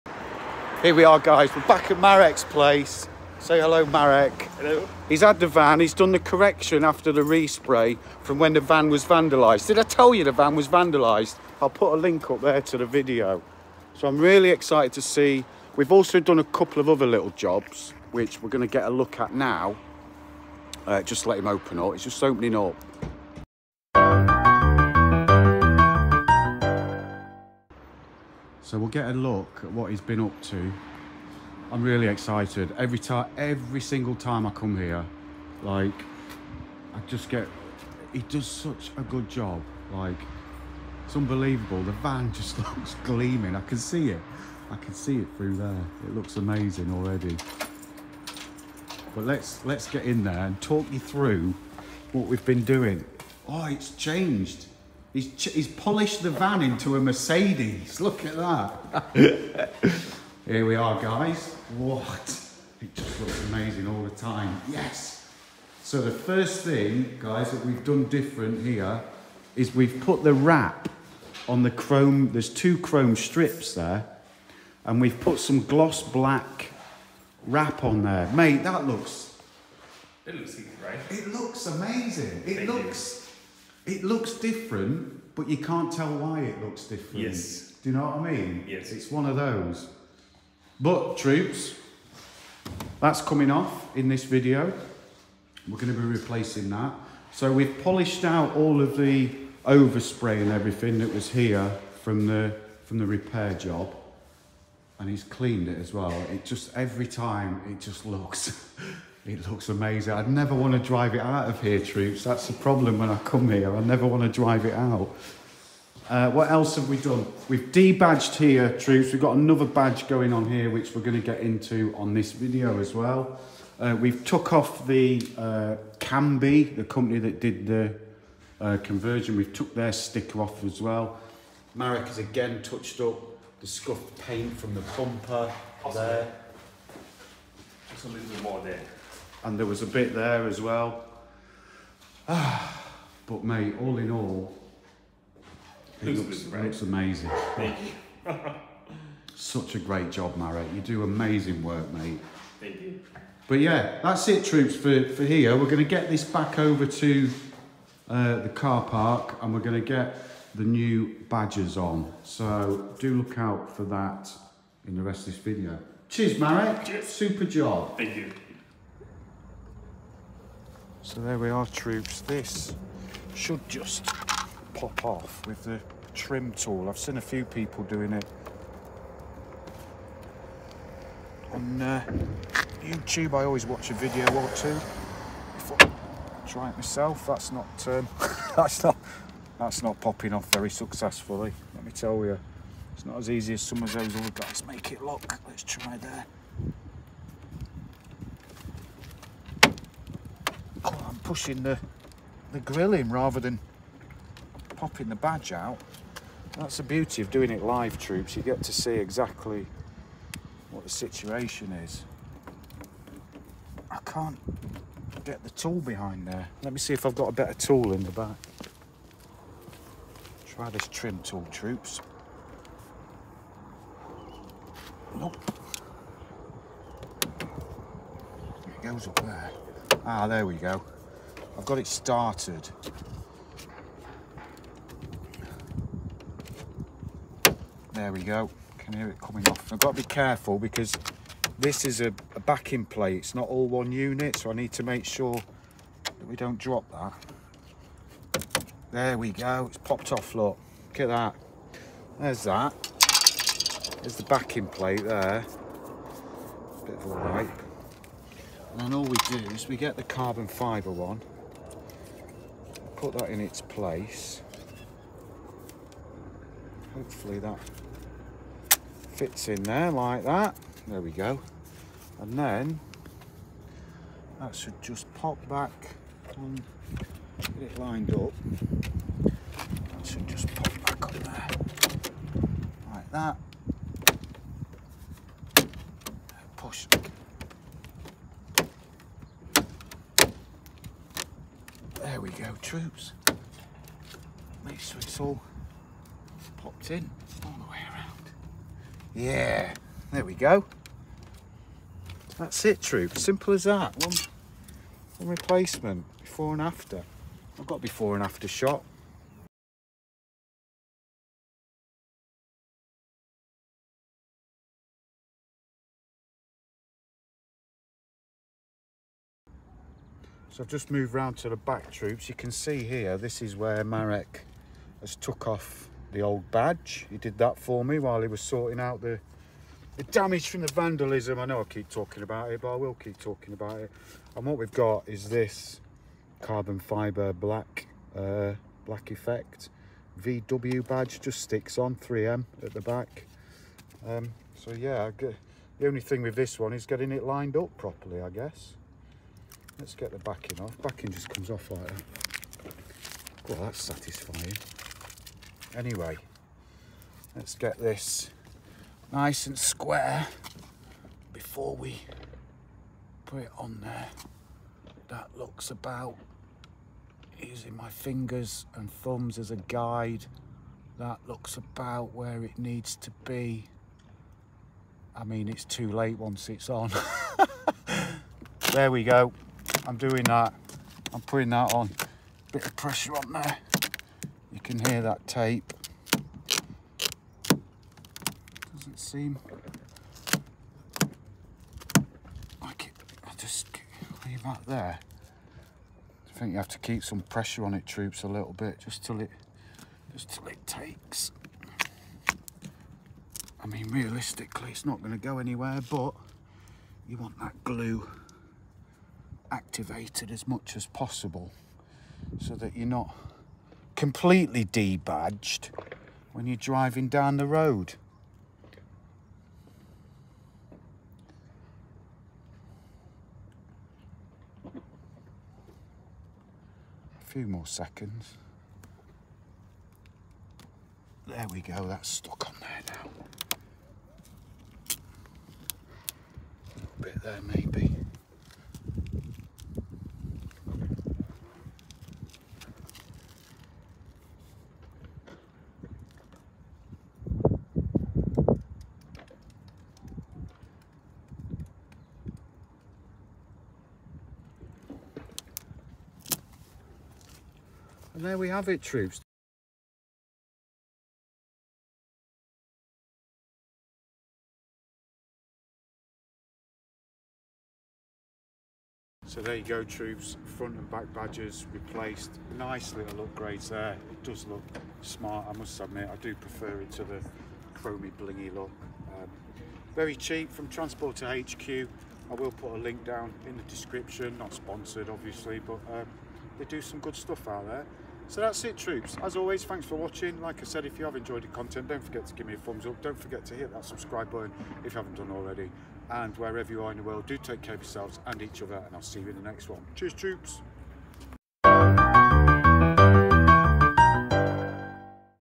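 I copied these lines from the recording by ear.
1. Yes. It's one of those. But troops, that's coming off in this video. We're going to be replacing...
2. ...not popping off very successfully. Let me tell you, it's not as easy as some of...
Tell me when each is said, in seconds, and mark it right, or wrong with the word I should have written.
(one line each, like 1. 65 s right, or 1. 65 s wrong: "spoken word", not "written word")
1. 88 s right
2. 189 s right.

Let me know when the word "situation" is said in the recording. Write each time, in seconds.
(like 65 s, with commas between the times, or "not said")
210 s.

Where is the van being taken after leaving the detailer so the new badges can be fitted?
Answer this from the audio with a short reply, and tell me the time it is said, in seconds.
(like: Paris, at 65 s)
The car park, at 158 s.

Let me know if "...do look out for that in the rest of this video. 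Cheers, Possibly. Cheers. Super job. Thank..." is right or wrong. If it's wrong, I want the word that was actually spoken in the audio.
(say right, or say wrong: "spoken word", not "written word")
wrong: "Marek", not "Possibly".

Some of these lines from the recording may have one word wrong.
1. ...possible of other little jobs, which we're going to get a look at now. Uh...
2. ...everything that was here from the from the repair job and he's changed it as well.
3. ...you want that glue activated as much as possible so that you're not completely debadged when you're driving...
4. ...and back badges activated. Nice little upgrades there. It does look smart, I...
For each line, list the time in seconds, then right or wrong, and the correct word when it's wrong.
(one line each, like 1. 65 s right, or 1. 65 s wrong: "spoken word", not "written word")
1. 16 s wrong: "couple", not "possible"
2. 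100 s wrong: "cleaned", not "changed"
3. 407 s right
4. 470 s wrong: "replaced", not "activated".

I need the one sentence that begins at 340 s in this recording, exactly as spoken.
VW badge just sticks on 3M at the back.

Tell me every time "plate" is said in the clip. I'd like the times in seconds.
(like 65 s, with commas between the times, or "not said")
242 s, 254 s.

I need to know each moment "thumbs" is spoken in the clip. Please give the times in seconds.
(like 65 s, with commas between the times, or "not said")
369 s, 492 s.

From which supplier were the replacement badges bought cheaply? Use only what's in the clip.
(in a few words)
Transporter HQ.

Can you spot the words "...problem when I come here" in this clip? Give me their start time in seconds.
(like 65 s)
112 s.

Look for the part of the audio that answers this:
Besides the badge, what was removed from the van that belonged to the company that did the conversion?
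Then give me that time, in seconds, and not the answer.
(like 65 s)
129 s.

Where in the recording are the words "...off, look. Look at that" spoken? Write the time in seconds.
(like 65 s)
250 s.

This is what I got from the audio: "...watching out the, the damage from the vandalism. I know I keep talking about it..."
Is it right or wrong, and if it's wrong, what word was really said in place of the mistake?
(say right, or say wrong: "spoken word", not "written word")
wrong: "sorting", not "watching".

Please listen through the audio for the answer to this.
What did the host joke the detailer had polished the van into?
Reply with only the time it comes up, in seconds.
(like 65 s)
56 s.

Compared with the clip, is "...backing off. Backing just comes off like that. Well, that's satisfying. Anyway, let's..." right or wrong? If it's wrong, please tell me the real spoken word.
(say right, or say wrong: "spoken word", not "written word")
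right.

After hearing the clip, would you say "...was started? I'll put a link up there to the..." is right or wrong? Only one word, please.
wrong.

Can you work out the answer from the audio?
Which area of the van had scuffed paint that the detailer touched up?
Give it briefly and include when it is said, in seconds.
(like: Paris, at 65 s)
The bumper, at 134 s.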